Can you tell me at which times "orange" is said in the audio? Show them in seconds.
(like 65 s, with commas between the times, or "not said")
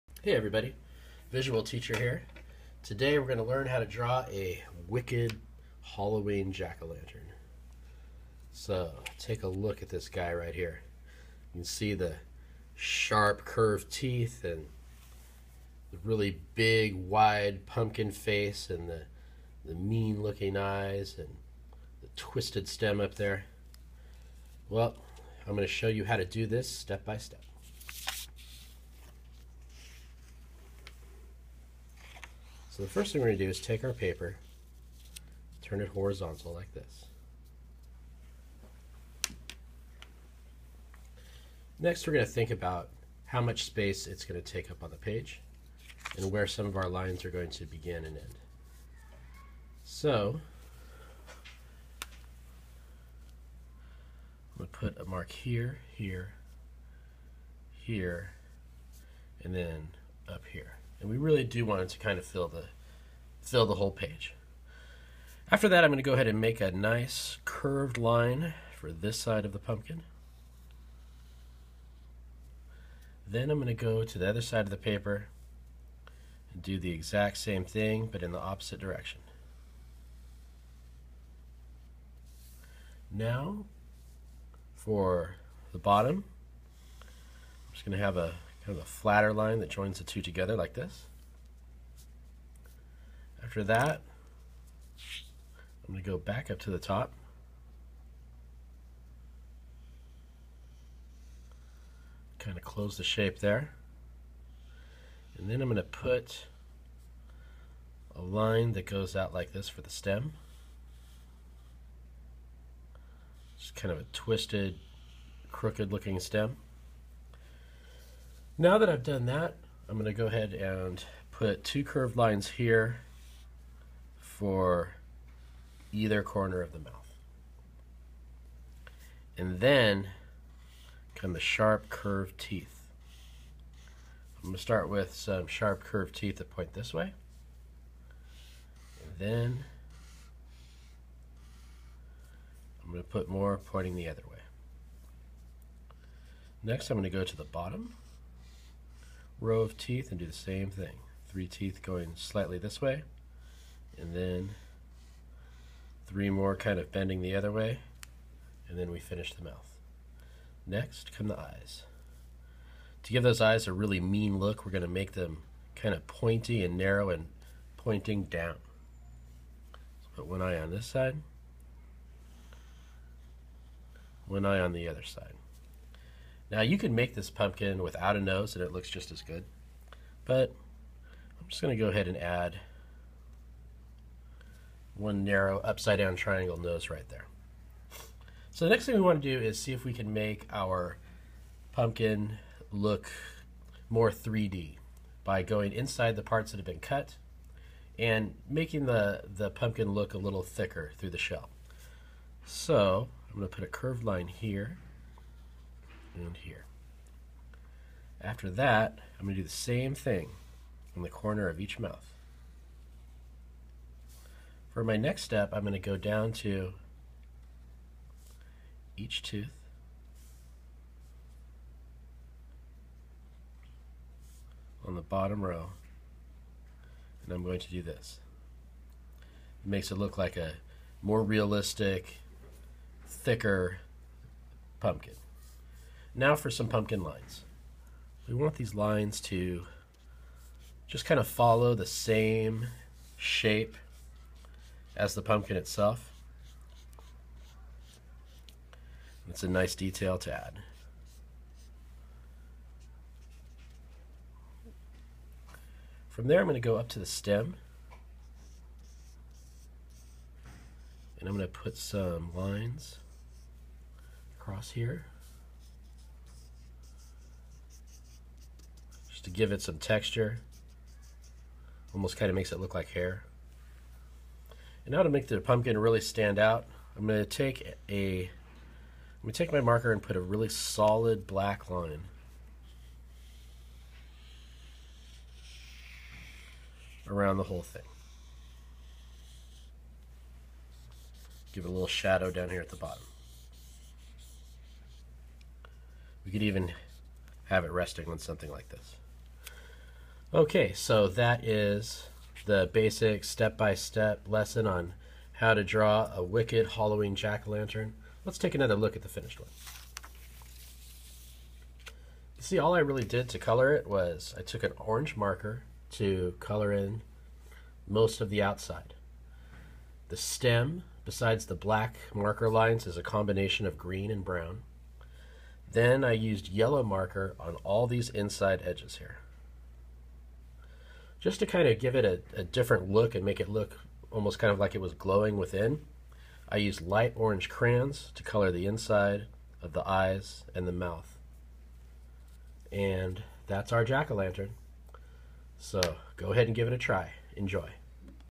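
314 s, 337 s.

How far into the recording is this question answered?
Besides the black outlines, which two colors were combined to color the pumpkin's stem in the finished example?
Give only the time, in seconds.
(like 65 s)
323 s.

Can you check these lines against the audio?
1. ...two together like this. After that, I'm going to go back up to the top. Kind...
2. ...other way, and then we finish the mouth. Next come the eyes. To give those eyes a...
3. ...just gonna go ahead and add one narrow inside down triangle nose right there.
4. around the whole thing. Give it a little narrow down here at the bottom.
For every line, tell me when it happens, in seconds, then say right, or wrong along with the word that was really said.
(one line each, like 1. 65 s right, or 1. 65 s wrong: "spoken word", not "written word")
1. 90 s right
2. 157 s right
3. 181 s wrong: "upside", not "inside"
4. 287 s wrong: "shadow", not "narrow".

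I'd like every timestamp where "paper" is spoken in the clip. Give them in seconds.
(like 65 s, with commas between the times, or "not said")
33 s, 74 s.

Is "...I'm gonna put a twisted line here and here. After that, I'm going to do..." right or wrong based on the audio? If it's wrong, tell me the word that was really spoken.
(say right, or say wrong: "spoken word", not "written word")
wrong: "curved", not "twisted".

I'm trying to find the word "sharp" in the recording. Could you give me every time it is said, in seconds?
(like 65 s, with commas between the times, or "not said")
12 s, 131 s, 135 s.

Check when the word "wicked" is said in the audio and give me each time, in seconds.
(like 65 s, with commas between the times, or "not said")
4 s, 306 s.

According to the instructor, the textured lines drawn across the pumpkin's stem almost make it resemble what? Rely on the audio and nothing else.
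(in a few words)
Hair.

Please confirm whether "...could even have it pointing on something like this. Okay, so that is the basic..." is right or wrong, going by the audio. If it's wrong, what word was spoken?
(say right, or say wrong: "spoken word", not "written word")
wrong: "resting", not "pointing".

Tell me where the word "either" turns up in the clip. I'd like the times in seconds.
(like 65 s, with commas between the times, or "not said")
125 s.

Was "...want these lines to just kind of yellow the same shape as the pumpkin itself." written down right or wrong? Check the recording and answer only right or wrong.
wrong.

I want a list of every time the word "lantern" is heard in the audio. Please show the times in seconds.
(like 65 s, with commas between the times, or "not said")
6 s, 307 s, 343 s.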